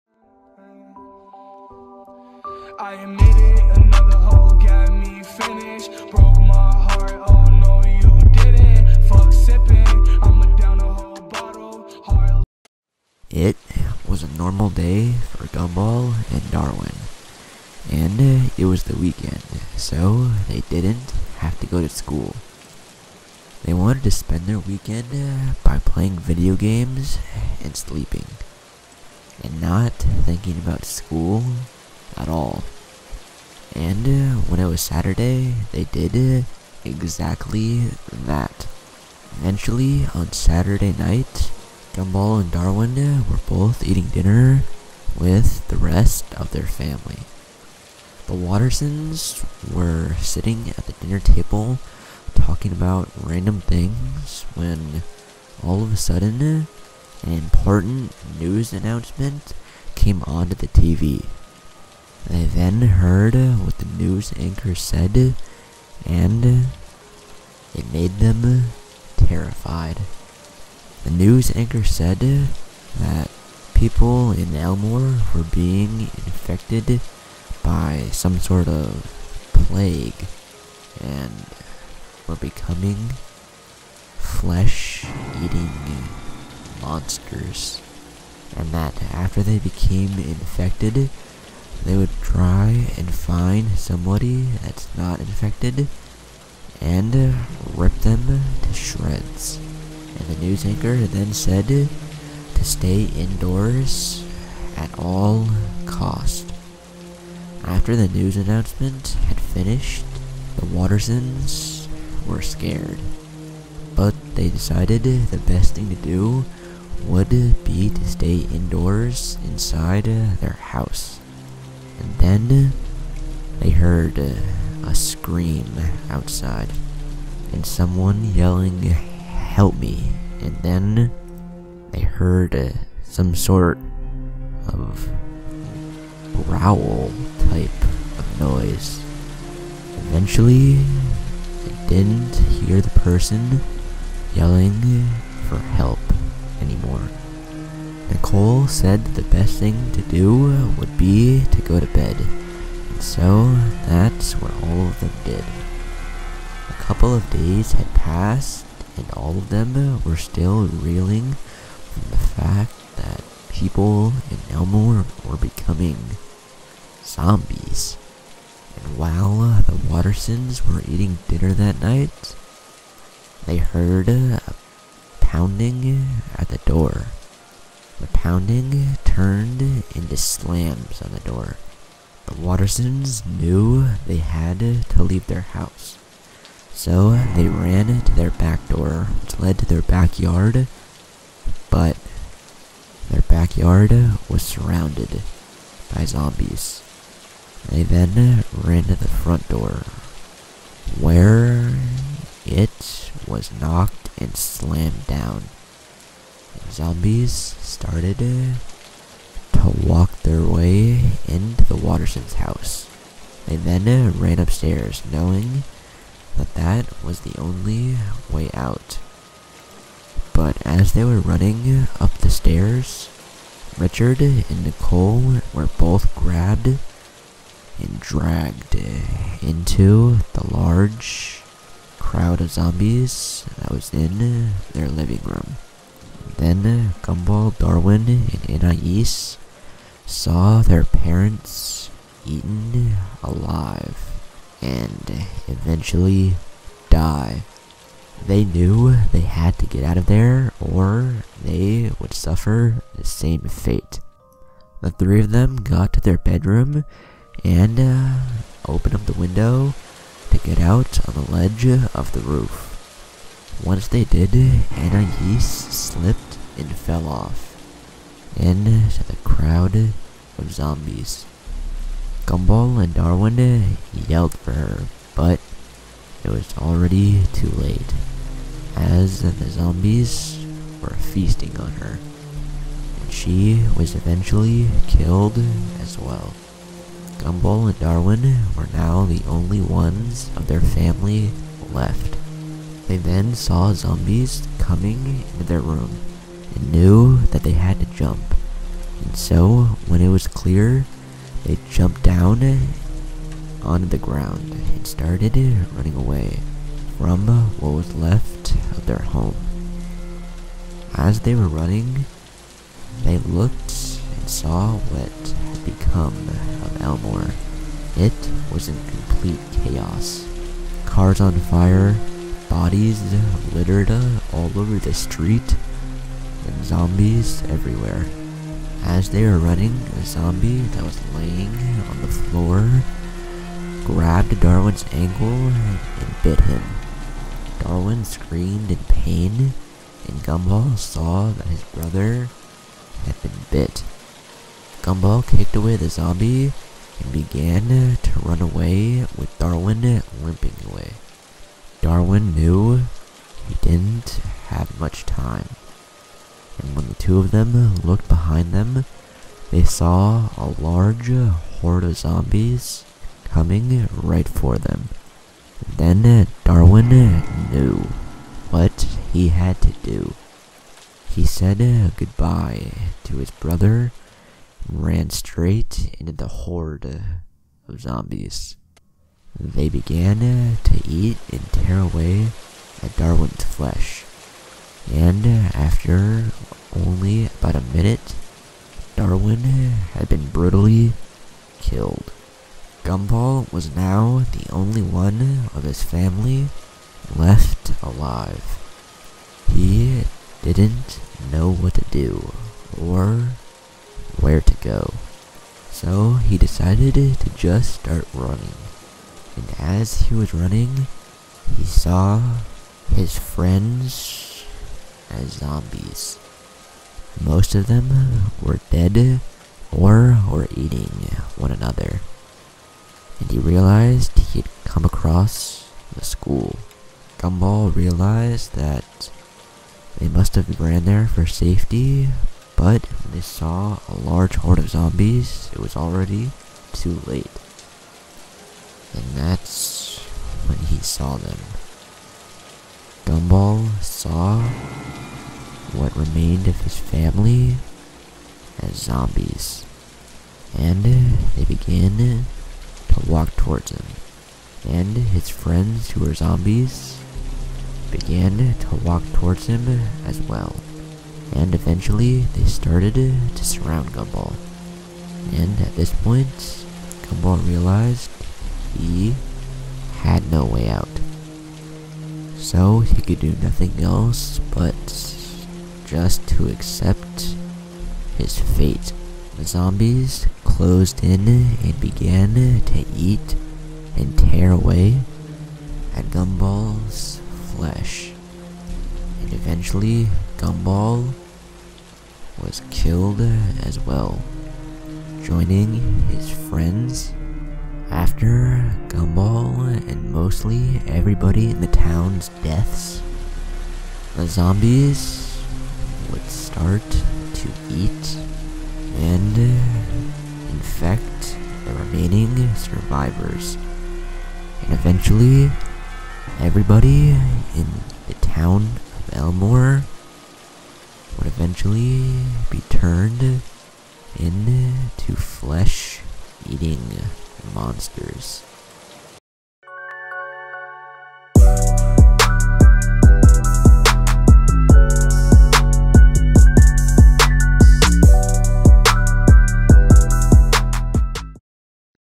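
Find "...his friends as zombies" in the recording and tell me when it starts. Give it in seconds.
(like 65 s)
412 s.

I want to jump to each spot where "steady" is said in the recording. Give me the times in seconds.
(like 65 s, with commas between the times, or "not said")
not said.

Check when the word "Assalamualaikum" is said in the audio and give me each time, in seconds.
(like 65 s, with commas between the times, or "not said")
not said.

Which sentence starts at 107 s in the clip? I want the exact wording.
After the news announcement had finished, the Watersons were scared.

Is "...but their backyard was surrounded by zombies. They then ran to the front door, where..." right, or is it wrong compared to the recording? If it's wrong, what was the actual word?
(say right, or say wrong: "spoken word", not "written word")
right.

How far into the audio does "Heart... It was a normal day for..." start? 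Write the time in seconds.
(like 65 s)
12 s.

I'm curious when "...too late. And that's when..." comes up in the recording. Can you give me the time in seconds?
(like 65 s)
436 s.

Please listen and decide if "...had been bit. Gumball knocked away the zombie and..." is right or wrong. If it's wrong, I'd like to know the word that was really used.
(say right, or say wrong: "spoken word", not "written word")
wrong: "kicked", not "knocked".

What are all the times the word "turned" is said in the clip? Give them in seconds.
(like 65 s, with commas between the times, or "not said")
179 s, 522 s.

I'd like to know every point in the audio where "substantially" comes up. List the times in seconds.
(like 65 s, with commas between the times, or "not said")
not said.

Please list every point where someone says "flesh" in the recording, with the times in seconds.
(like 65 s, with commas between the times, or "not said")
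84 s, 383 s, 487 s, 525 s.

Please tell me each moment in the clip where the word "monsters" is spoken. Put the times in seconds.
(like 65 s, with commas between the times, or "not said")
86 s, 527 s.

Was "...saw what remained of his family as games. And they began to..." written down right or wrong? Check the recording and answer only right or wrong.
wrong.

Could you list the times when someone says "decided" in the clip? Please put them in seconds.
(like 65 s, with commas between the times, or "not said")
114 s, 406 s.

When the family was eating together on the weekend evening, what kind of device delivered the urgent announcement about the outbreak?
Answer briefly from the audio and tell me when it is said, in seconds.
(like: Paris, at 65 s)
TV, at 60 s.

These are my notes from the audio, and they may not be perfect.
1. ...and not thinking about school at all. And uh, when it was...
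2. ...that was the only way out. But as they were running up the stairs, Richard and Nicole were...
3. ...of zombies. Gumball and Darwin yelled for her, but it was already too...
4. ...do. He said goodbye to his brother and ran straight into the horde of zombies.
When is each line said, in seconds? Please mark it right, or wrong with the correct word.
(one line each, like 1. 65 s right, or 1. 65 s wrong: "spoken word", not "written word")
1. 29 s right
2. 216 s right
3. 269 s right
4. 369 s right.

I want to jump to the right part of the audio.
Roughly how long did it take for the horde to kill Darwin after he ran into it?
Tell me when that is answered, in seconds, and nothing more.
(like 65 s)
387 s.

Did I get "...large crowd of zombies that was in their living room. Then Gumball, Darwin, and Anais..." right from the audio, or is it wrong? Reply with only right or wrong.
right.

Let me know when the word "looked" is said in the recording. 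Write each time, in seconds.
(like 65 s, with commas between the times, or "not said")
313 s, 357 s.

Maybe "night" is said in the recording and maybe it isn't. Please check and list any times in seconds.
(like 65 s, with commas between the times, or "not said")
40 s, 171 s.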